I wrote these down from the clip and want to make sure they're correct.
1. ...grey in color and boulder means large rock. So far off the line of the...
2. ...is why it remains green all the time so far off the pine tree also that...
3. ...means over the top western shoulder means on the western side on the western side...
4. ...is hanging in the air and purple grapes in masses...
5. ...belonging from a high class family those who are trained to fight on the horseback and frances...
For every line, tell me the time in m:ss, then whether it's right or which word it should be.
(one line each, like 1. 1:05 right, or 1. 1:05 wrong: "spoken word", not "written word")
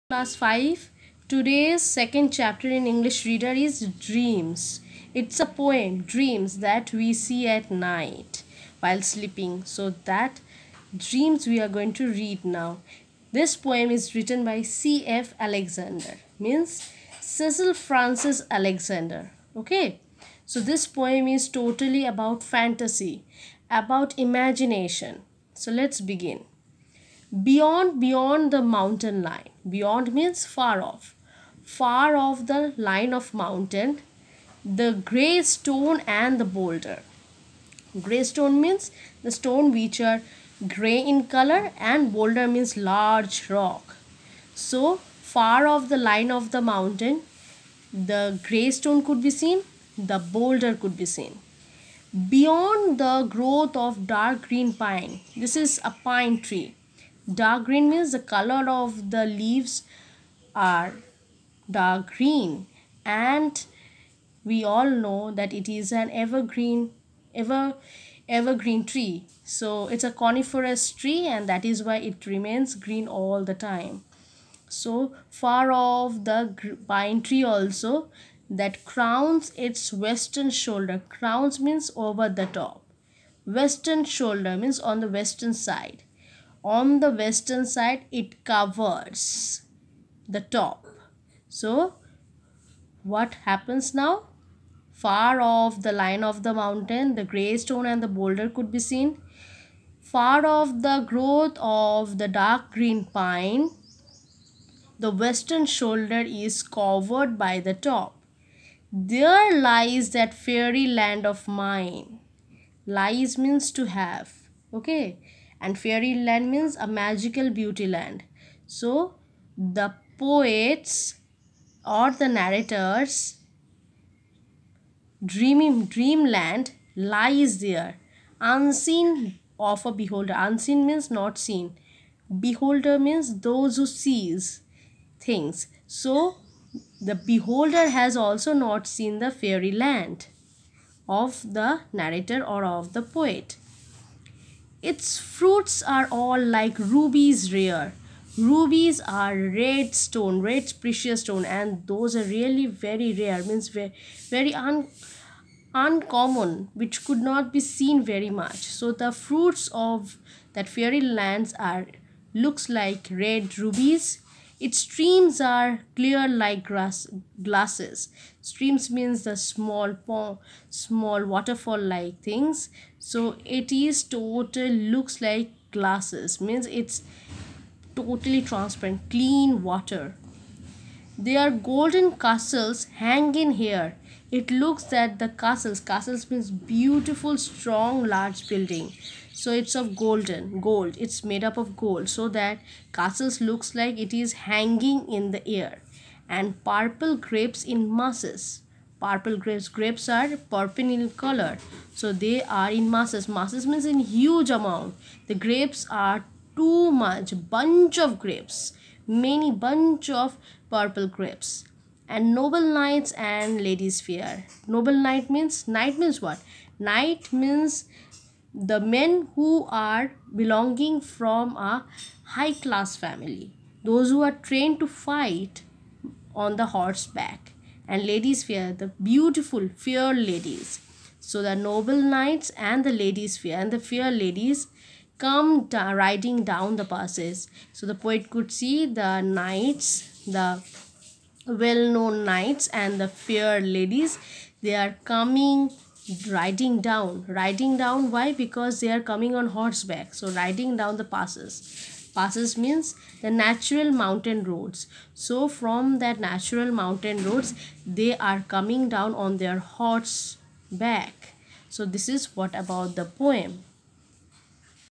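1. 0:40 right
2. 1:11 right
3. 1:21 right
4. 3:14 right
5. 3:40 wrong: "ladies", not "frances".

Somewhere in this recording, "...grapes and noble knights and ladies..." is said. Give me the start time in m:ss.
3:31.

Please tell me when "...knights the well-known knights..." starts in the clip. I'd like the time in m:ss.
3:59.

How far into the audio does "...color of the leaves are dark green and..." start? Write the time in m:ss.
0:58.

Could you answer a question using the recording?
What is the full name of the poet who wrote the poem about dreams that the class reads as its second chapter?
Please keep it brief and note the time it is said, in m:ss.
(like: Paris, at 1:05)
Cecil Frances Alexander, at 0:17.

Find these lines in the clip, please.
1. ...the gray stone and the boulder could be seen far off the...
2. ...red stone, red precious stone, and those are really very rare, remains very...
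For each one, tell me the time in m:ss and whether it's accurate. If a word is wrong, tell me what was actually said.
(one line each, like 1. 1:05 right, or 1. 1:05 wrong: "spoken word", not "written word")
1. 1:37 right
2. 2:29 wrong: "means", not "remains".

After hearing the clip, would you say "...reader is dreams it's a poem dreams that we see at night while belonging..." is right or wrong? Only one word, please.
wrong.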